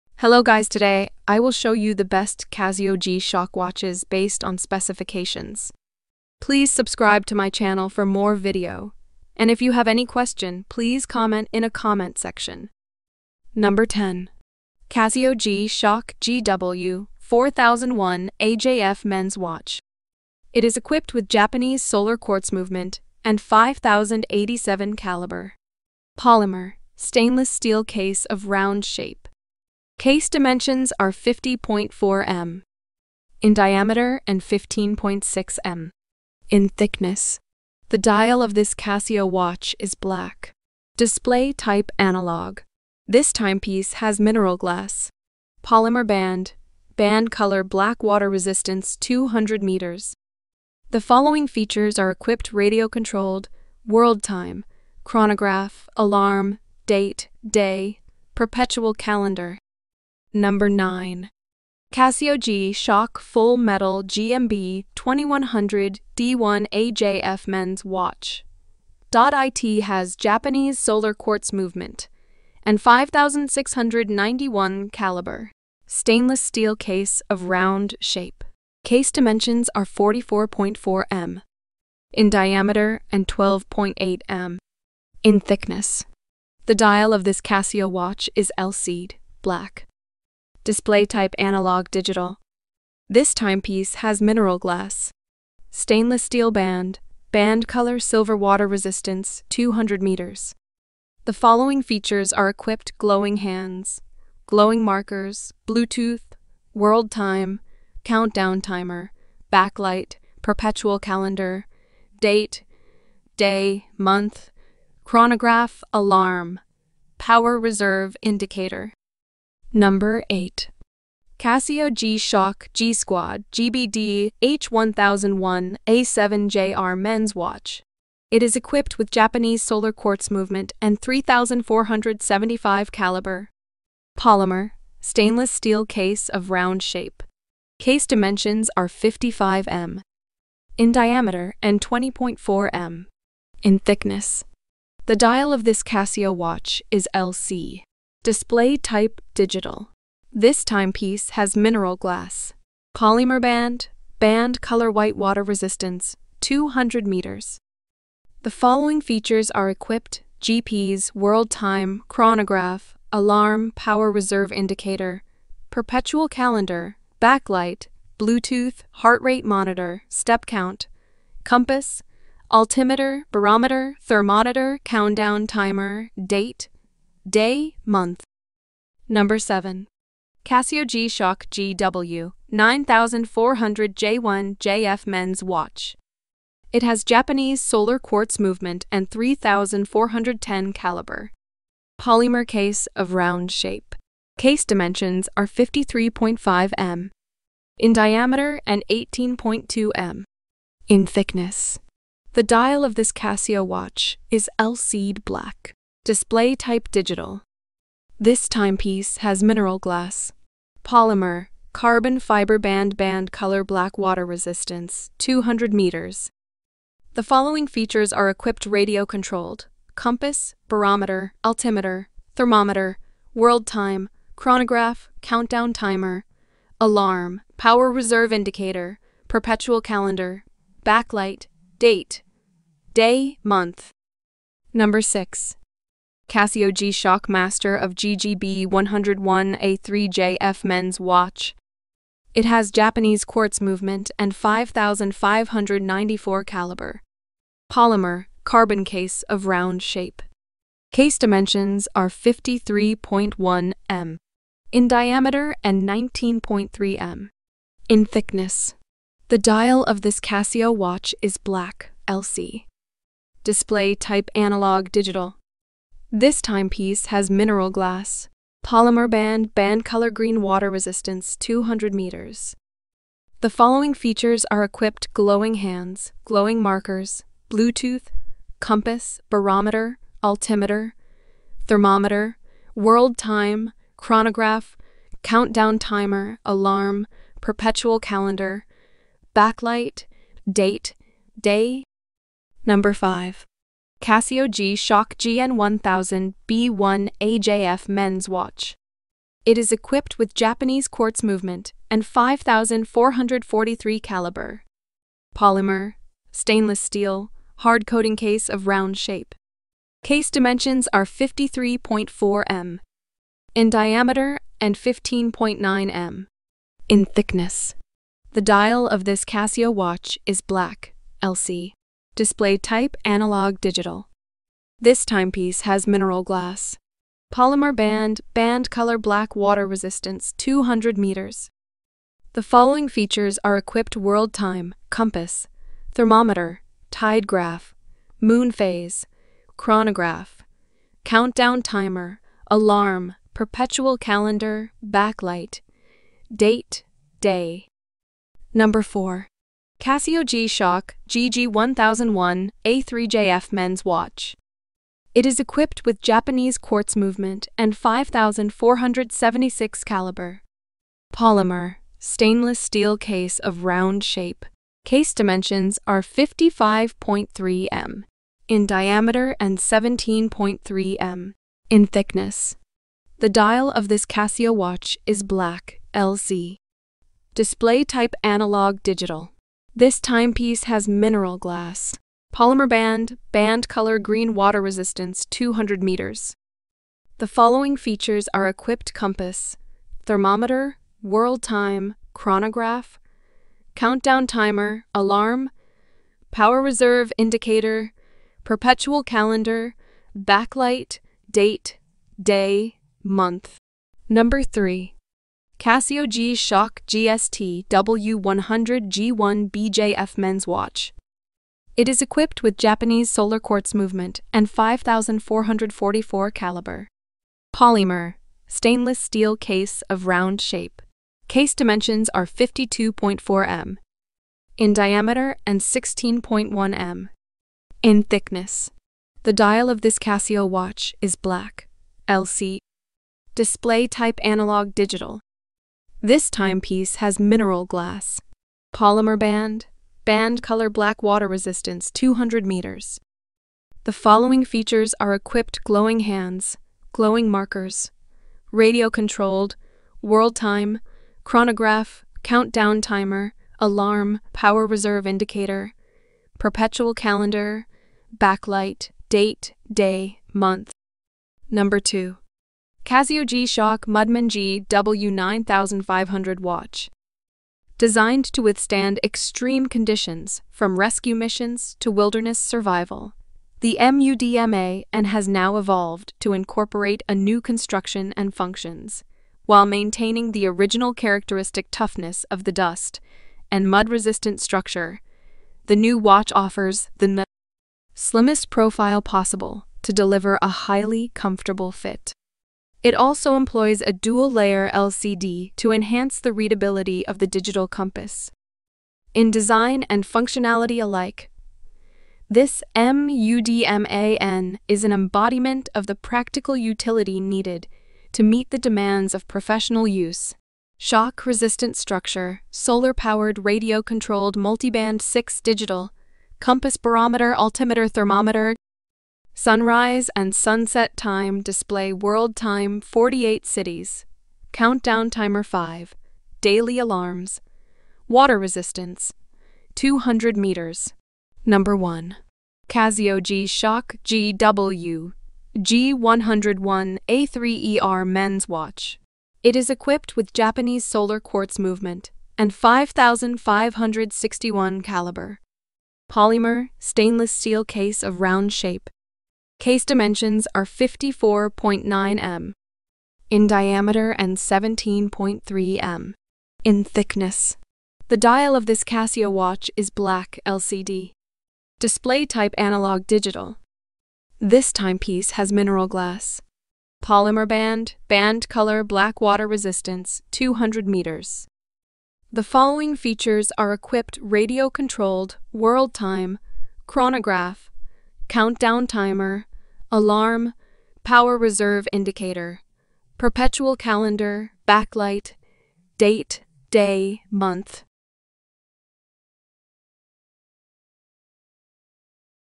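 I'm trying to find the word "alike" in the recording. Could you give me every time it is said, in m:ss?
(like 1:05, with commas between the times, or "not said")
8:20.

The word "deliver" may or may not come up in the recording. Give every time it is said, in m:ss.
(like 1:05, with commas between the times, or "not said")
8:09.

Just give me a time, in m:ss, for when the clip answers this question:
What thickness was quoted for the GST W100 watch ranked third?
7:05.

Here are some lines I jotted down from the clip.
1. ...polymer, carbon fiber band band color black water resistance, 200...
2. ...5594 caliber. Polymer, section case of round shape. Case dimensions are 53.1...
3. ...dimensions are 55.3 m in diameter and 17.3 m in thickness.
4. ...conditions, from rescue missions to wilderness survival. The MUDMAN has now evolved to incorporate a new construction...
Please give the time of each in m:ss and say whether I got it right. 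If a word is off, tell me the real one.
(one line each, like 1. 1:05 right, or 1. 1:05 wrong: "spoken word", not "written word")
1. 3:30 right
2. 4:04 wrong: "carbon", not "section"
3. 6:05 right
4. 7:49 right.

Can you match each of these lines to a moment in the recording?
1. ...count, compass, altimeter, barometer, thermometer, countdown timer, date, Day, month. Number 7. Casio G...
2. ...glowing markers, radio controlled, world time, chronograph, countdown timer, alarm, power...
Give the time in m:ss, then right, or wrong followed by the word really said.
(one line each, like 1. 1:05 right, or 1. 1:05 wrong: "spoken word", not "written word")
1. 2:50 right
2. 7:26 right.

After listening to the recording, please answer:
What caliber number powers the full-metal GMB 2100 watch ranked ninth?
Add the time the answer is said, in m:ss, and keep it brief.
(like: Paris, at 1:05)
5691, at 1:12.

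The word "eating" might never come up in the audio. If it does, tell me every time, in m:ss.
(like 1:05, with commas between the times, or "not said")
not said.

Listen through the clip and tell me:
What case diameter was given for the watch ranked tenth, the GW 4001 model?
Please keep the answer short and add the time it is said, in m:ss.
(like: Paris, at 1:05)
50.4 mm, at 0:31.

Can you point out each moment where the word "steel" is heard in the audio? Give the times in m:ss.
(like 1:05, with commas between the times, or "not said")
0:27, 1:16, 1:36, 2:15, 5:06, 6:02, 6:58, 9:07.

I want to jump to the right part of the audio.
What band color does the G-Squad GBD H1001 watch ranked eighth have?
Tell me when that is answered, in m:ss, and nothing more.
2:34.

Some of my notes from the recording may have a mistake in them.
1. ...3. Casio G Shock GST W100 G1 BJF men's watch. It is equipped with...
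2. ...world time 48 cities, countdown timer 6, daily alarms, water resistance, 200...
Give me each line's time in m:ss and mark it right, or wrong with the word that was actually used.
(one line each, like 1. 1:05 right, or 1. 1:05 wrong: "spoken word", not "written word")
1. 6:44 right
2. 8:41 wrong: "5", not "6".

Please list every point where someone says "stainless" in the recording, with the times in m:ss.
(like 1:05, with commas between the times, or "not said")
0:26, 1:15, 1:35, 2:14, 5:06, 6:01, 6:58, 9:06.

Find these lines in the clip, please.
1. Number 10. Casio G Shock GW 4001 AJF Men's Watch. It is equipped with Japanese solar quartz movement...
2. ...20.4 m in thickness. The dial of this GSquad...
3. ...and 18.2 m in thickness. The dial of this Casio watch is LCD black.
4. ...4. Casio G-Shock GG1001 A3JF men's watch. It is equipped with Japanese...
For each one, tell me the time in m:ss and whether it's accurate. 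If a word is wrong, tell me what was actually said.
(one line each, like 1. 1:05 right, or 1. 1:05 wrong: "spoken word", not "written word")
1. 0:13 right
2. 2:21 wrong: "Casio", not "GSquad"
3. 3:18 right
4. 5:48 right.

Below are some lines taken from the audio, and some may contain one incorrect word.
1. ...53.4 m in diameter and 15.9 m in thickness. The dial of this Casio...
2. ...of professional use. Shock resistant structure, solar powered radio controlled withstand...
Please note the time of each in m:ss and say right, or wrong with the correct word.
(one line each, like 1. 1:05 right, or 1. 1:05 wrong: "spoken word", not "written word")
1. 5:11 right
2. 8:29 wrong: "multiband", not "withstand".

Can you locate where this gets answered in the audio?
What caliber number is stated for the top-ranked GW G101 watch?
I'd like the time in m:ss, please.
9:02.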